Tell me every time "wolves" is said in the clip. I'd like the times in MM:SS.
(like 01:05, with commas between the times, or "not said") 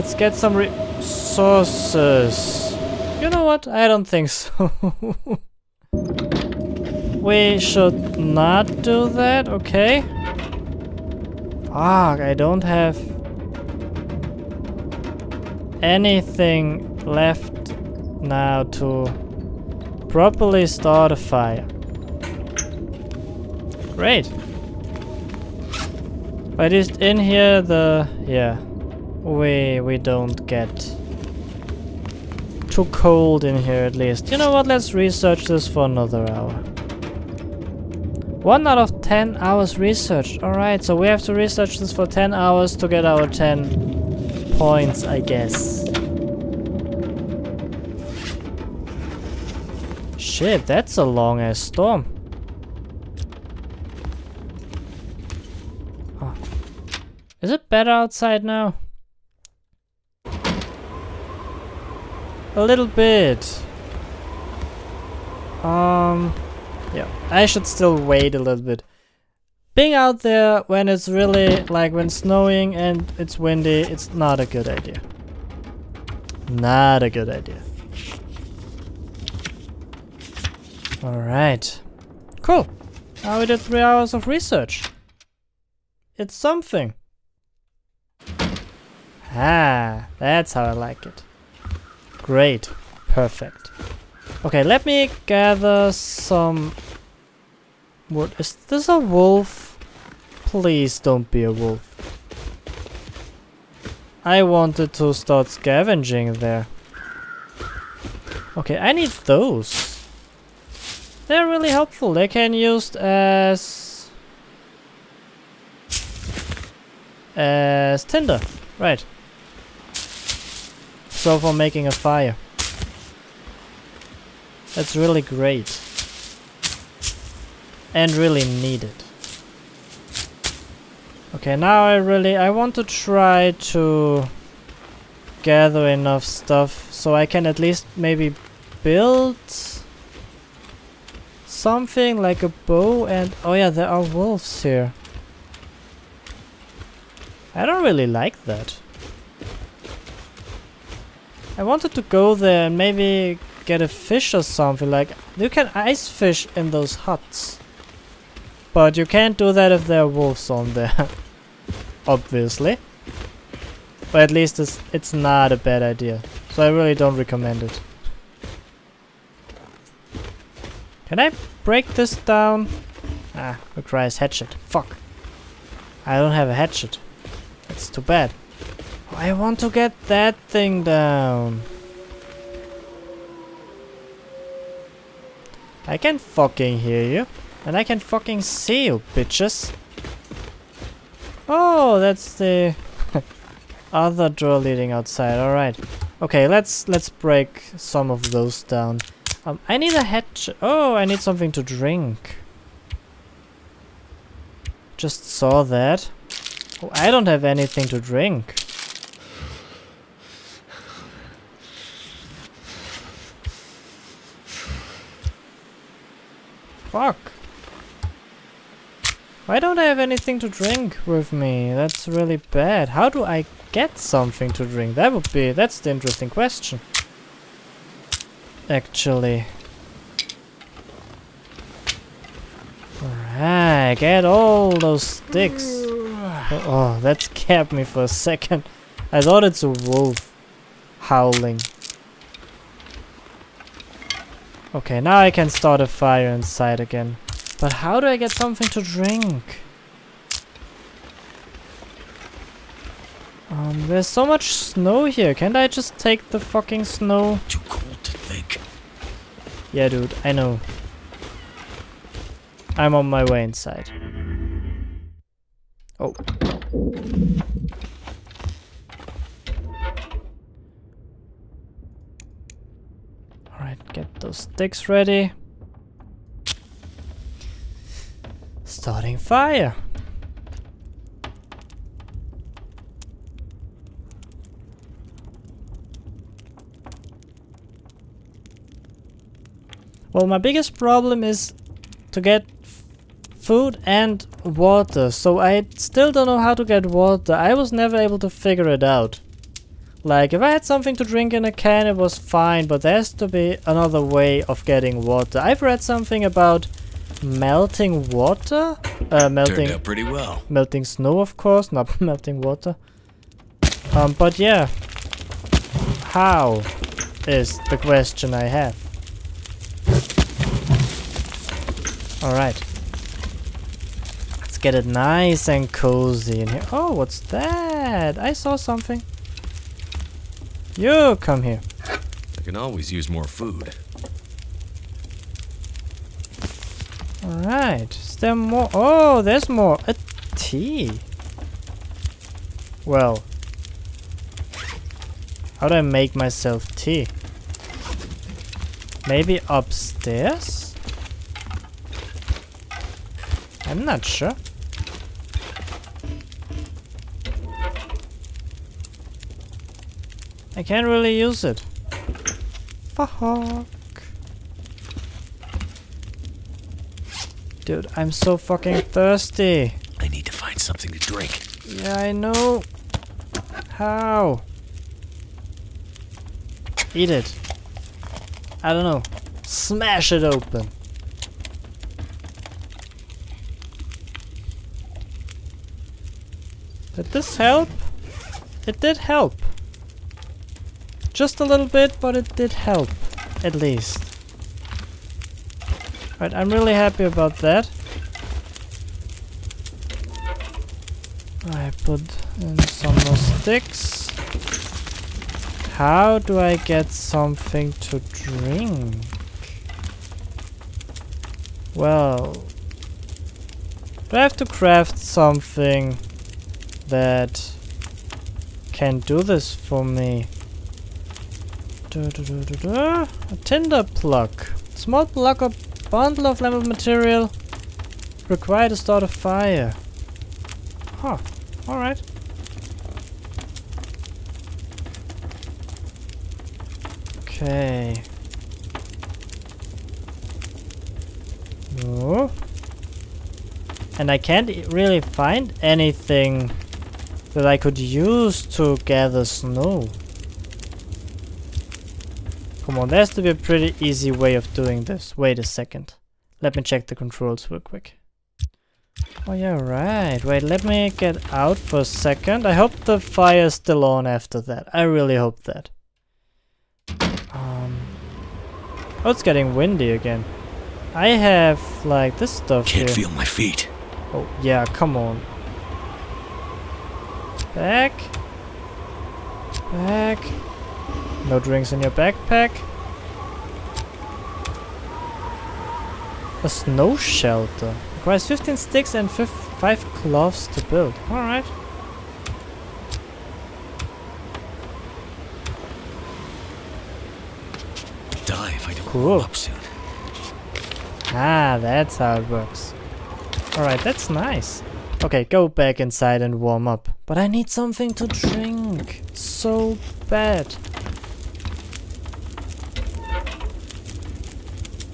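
02:24, 02:40.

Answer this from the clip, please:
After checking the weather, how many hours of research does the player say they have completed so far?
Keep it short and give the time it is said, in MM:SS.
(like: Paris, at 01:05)
3, at 01:23.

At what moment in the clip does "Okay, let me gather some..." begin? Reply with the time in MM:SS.
01:34.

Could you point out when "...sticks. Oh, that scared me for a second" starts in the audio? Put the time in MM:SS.
03:55.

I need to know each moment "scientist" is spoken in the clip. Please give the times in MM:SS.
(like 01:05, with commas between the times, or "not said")
not said.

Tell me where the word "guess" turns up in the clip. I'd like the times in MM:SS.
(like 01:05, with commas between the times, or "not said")
00:45.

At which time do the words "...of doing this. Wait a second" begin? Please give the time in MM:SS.
07:34.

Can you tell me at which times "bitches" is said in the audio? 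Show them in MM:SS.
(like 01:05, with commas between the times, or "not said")
03:09.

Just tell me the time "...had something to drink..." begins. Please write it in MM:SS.
05:00.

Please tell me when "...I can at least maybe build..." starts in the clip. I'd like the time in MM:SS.
02:17.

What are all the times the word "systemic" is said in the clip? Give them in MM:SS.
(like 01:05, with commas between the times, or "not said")
not said.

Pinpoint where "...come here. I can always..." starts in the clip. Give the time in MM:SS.
05:31.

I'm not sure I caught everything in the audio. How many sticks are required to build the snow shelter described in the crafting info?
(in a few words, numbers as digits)
15.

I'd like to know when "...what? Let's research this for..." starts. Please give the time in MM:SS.
00:34.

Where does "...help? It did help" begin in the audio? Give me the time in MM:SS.
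06:27.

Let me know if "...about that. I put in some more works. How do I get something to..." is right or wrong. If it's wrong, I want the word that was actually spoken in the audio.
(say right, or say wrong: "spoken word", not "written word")
wrong: "sticks", not "works".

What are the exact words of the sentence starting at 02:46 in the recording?
So I really don't recommend it.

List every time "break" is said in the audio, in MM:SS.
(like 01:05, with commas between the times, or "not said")
02:51, 03:17.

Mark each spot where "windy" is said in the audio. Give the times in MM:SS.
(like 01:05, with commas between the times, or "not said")
01:13, 07:49.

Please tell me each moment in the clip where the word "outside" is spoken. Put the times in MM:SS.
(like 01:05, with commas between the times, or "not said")
00:57, 03:14.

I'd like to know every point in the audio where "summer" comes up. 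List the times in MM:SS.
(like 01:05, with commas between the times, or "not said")
not said.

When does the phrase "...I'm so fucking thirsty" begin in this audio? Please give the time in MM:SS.
06:07.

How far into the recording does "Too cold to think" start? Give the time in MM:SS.
04:17.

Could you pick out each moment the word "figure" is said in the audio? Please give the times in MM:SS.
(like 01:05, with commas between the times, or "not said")
04:58.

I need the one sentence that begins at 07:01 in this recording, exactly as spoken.
Da, da, da, a tinder plug.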